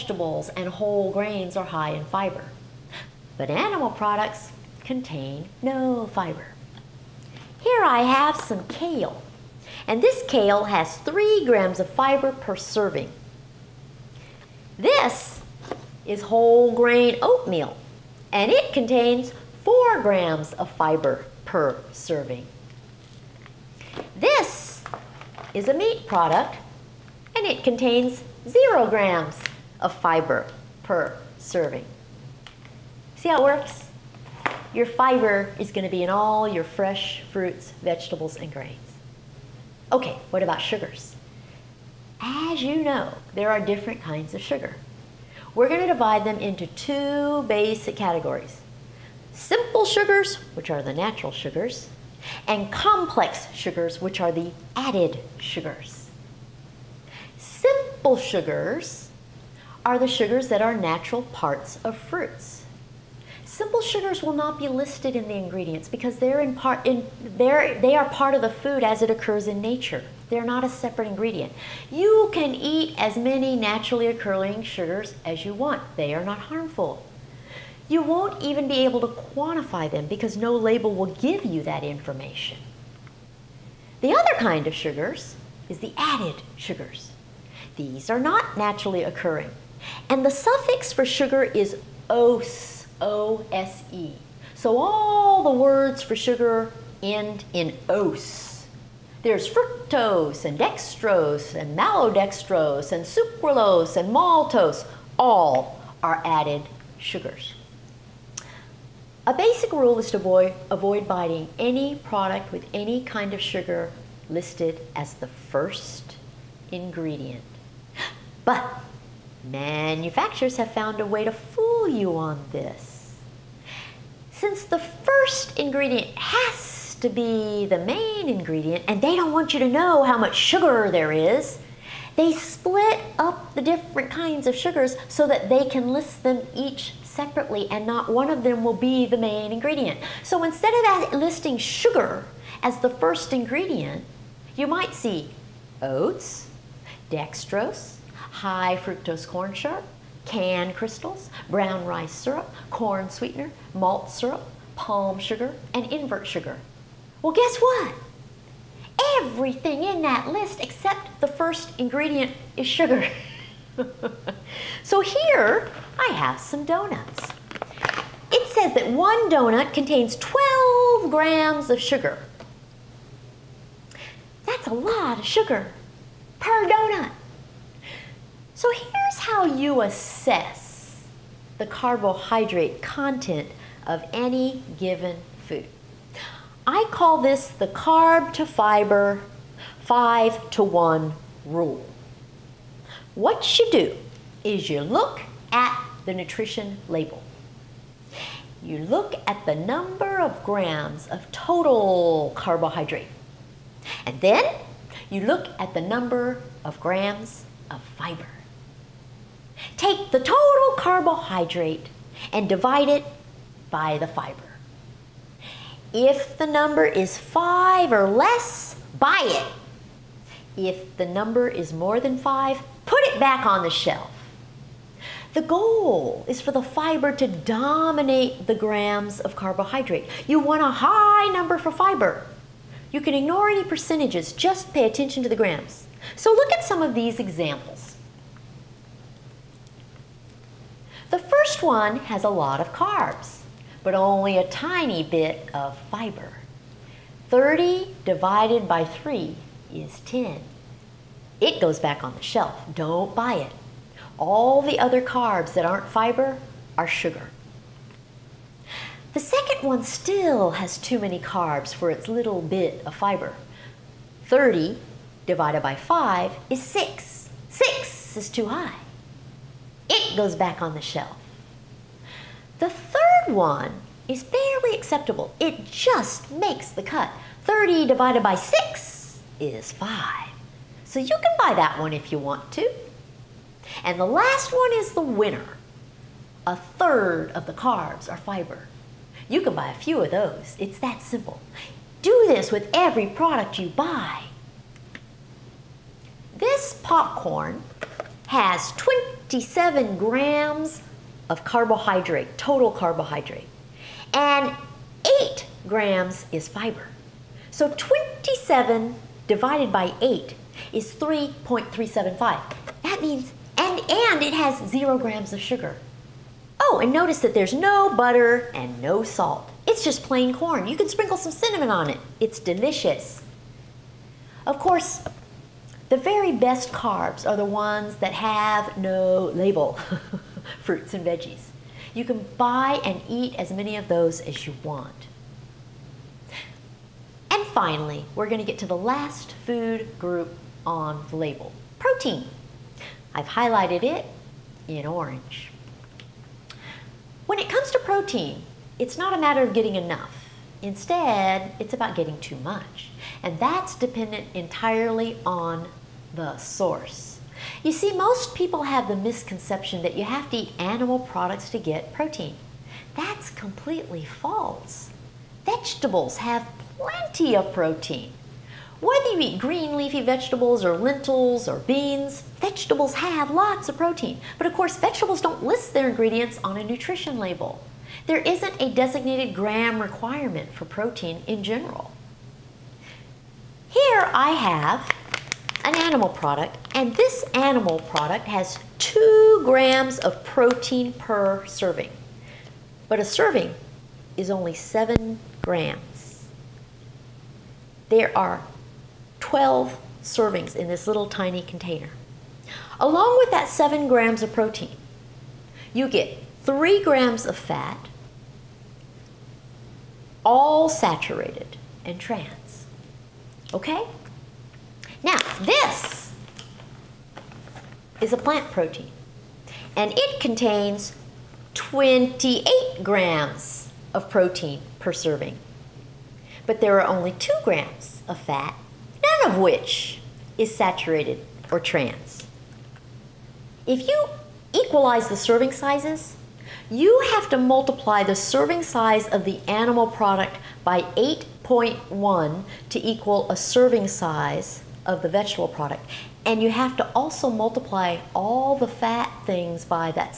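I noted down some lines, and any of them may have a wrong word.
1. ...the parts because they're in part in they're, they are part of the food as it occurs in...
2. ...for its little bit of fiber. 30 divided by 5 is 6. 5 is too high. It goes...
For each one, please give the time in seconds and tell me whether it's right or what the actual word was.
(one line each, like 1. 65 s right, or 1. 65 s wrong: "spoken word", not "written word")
1. 65 s wrong: "ingredients", not "parts"
2. 261 s wrong: "6", not "5".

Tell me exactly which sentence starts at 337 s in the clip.
And finally, we're going to get to the last food group on the label, protein.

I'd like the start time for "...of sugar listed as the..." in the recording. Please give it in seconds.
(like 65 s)
113 s.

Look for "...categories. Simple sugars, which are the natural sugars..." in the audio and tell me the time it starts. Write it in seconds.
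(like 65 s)
47 s.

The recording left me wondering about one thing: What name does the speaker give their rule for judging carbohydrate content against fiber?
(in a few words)
carb to fiber 5 to 1 rule.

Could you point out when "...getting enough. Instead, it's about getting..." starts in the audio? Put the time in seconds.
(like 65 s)
349 s.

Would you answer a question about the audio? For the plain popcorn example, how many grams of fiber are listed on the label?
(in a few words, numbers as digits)
8 grams.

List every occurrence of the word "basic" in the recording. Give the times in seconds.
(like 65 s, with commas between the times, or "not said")
47 s, 109 s.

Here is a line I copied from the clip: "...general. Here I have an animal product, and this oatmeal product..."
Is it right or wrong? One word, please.
wrong.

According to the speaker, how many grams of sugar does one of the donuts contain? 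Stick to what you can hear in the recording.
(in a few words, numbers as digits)
12 grams.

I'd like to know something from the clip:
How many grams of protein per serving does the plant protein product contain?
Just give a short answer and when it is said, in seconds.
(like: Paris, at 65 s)
28 grams, at 421 s.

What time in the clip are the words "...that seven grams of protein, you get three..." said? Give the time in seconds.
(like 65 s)
403 s.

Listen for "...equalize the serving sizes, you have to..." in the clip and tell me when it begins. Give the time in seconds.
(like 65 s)
434 s.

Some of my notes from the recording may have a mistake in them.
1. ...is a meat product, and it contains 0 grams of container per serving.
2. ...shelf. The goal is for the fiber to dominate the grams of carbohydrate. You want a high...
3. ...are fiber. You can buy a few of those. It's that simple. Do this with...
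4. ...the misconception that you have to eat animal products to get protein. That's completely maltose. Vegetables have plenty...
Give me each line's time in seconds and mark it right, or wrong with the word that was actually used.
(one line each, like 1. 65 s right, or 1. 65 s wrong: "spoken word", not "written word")
1. 25 s wrong: "fiber", not "container"
2. 223 s right
3. 288 s right
4. 358 s wrong: "false", not "maltose".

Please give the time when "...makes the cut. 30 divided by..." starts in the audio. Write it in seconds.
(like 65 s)
276 s.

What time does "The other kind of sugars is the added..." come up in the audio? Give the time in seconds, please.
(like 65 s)
84 s.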